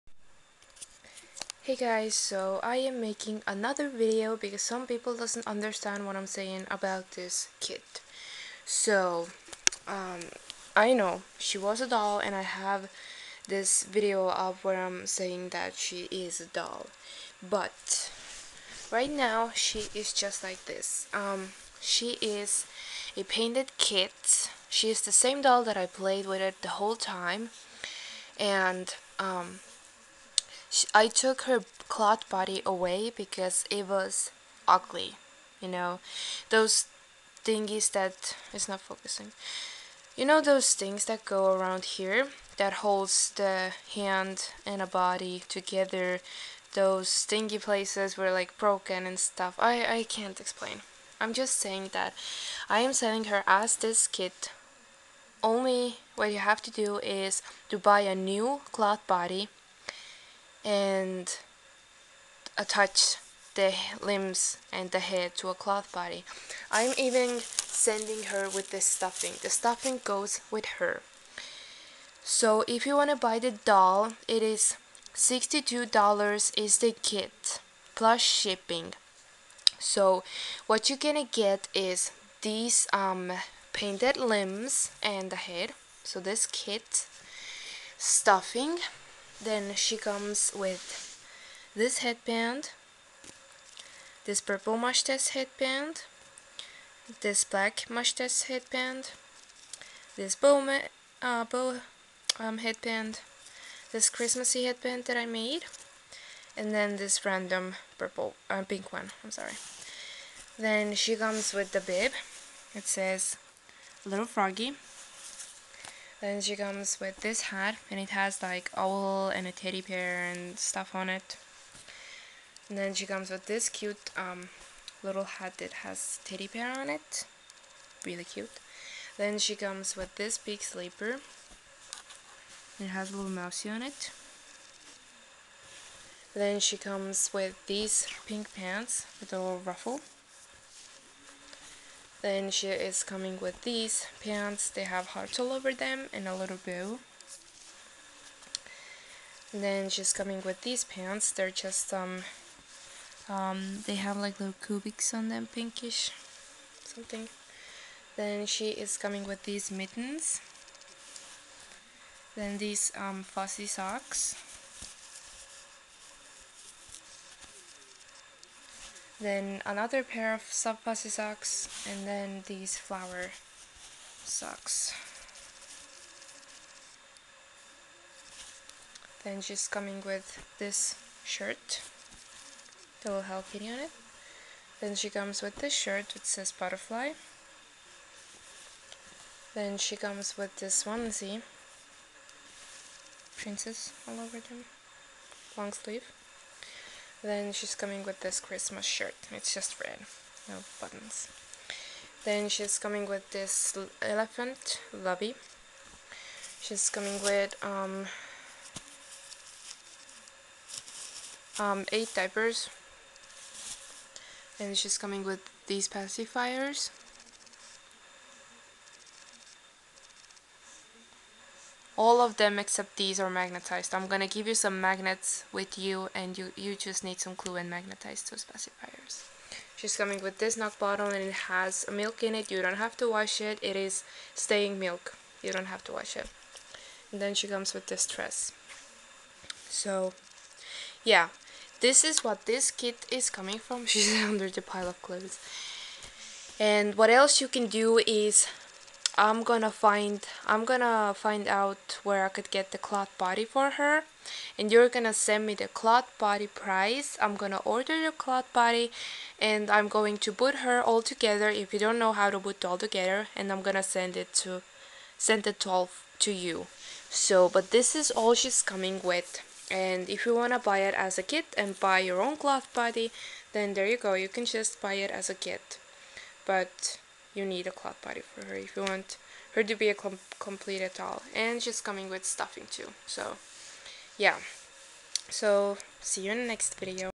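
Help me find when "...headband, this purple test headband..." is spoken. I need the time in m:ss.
1:31.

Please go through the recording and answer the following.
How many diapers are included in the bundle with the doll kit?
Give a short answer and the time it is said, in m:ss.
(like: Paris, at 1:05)
8, at 3:31.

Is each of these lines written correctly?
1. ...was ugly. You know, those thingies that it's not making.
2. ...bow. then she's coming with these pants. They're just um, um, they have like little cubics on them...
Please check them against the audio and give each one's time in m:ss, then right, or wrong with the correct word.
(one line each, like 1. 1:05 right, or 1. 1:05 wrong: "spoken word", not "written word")
1. 0:33 wrong: "focusing", not "making"
2. 2:26 right.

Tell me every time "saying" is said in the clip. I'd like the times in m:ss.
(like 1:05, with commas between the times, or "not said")
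0:06, 0:15, 0:51.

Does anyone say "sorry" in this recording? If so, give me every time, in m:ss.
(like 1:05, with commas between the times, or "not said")
1:49.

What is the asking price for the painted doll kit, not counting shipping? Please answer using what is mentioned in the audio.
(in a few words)
$62.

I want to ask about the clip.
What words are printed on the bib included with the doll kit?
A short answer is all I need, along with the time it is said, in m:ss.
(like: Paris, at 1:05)
Little Froggy, at 1:54.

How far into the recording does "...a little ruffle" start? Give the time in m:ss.
2:19.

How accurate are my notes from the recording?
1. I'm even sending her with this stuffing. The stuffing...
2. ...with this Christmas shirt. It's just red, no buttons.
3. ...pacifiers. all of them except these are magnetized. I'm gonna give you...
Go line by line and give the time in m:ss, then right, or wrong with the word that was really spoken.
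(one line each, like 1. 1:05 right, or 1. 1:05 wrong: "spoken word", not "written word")
1. 1:06 right
2. 3:18 right
3. 3:35 right.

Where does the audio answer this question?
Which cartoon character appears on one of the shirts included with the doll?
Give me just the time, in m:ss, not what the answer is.
3:03.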